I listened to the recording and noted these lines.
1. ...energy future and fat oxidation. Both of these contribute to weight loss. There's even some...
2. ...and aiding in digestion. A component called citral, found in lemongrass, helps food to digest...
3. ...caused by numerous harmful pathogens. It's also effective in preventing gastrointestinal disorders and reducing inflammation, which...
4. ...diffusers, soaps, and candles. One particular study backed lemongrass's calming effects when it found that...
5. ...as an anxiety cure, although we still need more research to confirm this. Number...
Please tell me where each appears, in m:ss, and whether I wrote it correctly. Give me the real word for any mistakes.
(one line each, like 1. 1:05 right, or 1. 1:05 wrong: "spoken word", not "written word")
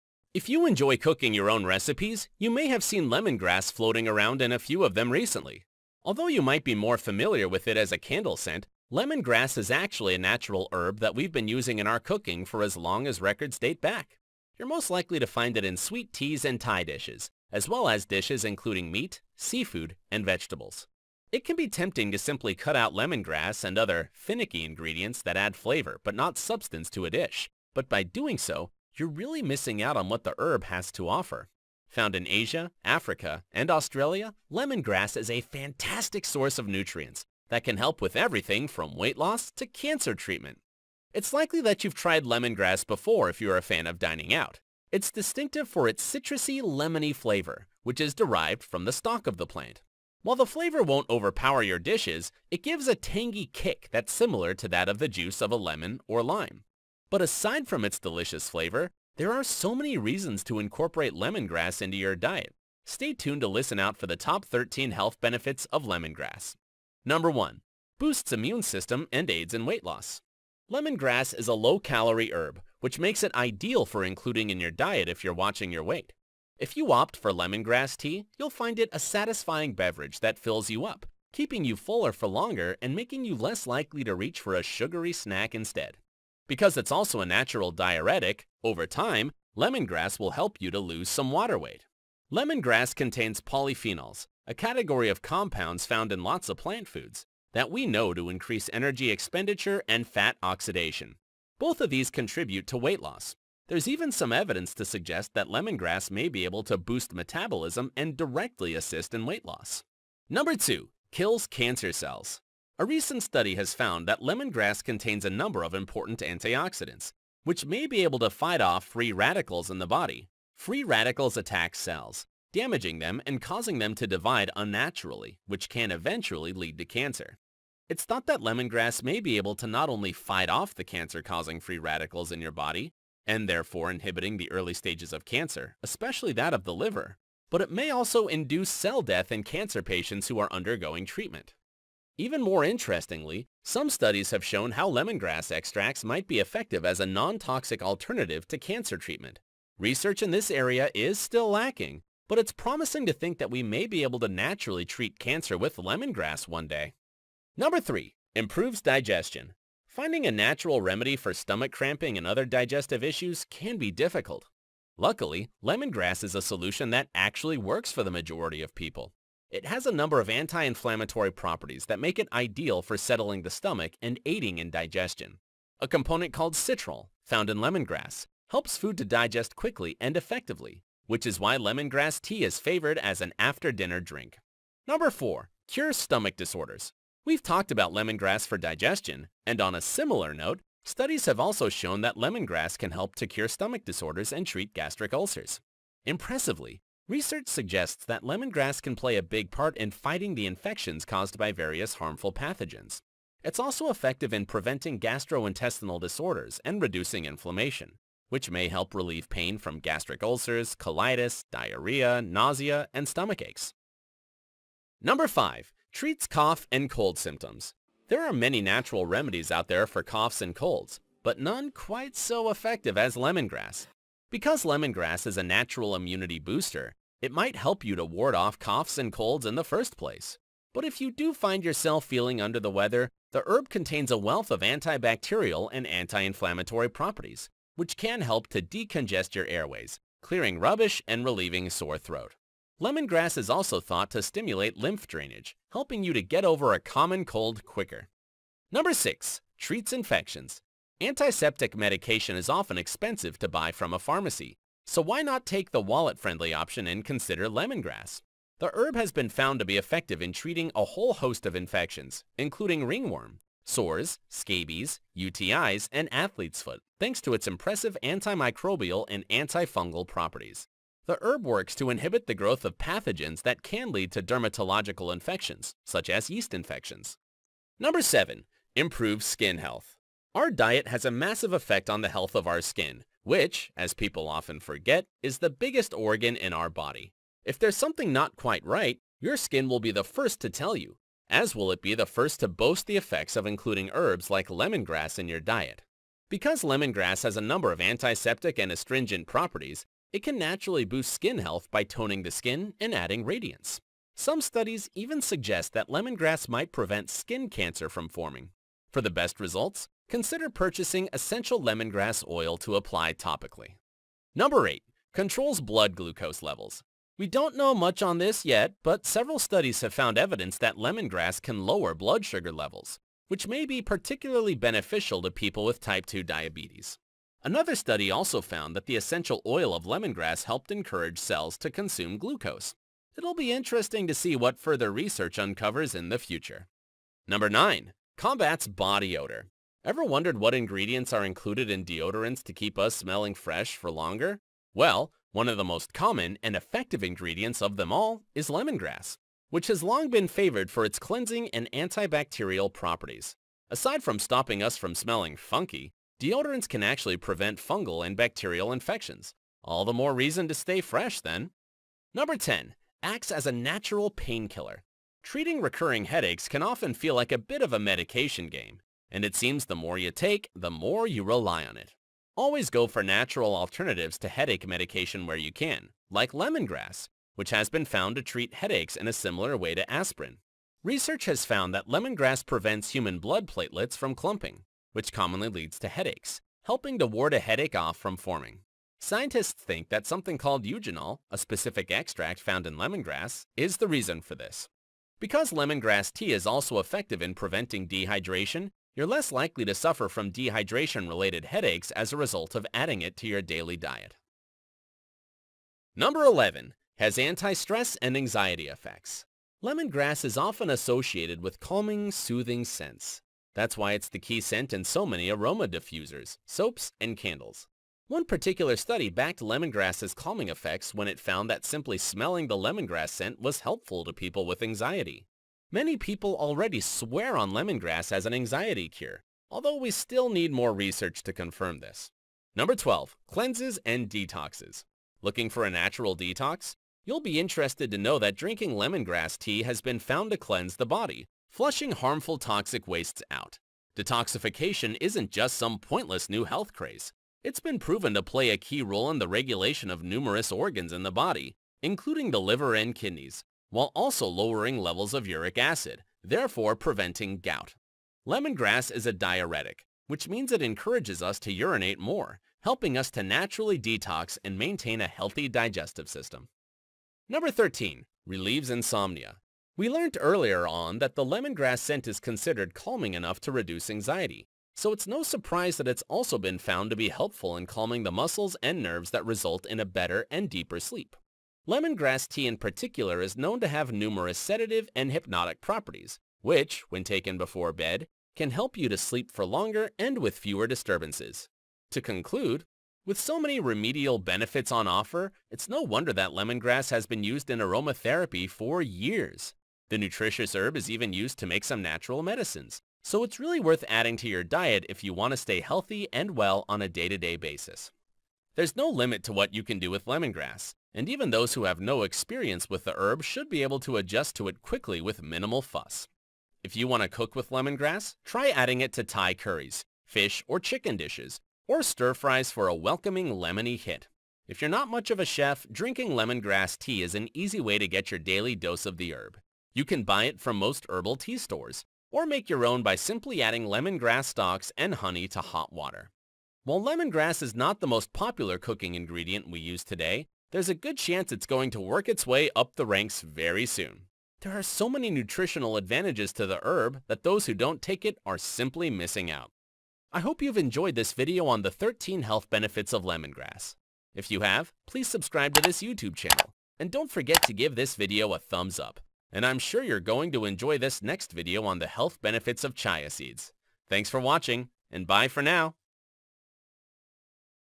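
1. 1:38 wrong: "expenditure", not "future"
2. 2:54 right
3. 3:21 wrong: "various", not "numerous"
4. 6:55 right
5. 7:08 right.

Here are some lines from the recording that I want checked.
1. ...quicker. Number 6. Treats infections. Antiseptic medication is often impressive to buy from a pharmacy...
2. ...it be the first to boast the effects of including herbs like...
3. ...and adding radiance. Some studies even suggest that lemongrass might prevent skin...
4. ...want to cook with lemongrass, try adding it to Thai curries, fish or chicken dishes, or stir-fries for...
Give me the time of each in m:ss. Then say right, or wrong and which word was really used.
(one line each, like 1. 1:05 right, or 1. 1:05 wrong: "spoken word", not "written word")
1. 4:07 wrong: "expensive", not "impressive"
2. 4:51 right
3. 5:02 right
4. 8:36 right.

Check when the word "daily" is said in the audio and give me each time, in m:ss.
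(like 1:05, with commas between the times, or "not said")
6:43, 8:48.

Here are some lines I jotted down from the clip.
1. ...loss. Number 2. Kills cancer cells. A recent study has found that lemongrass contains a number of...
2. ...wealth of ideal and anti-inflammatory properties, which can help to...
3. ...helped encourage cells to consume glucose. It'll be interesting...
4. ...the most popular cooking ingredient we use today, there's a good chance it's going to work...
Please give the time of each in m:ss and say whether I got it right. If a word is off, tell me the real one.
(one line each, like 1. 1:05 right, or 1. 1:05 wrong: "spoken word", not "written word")
1. 1:49 right
2. 3:54 wrong: "antibacterial", not "ideal"
3. 5:30 right
4. 8:57 right.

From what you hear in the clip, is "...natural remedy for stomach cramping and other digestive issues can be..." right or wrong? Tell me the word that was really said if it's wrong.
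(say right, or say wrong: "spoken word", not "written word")
right.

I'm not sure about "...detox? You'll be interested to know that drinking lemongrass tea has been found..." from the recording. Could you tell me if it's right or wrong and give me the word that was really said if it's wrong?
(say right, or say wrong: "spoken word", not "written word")
right.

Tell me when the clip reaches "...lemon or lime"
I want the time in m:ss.
0:55.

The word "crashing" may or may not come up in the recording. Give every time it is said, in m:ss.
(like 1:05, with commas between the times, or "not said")
not said.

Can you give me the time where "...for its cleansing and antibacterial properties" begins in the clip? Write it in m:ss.
5:50.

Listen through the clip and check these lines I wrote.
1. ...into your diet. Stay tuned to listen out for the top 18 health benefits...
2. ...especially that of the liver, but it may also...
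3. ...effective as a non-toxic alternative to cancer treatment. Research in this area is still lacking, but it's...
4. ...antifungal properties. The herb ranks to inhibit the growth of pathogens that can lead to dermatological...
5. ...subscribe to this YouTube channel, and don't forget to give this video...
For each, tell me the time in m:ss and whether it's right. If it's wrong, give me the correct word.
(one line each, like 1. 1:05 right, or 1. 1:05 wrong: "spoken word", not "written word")
1. 1:01 wrong: "13", not "18"
2. 2:15 right
3. 2:26 right
4. 4:29 wrong: "works", not "ranks"
5. 9:15 right.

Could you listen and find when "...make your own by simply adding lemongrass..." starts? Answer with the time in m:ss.
8:52.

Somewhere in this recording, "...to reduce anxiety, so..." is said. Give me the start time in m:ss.
7:53.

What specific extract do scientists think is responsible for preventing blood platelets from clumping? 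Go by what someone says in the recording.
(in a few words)
Eugenol.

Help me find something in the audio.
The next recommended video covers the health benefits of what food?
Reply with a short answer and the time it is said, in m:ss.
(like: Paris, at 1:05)
Chia seeds, at 9:22.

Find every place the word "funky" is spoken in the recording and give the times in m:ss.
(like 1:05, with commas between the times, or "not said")
5:55.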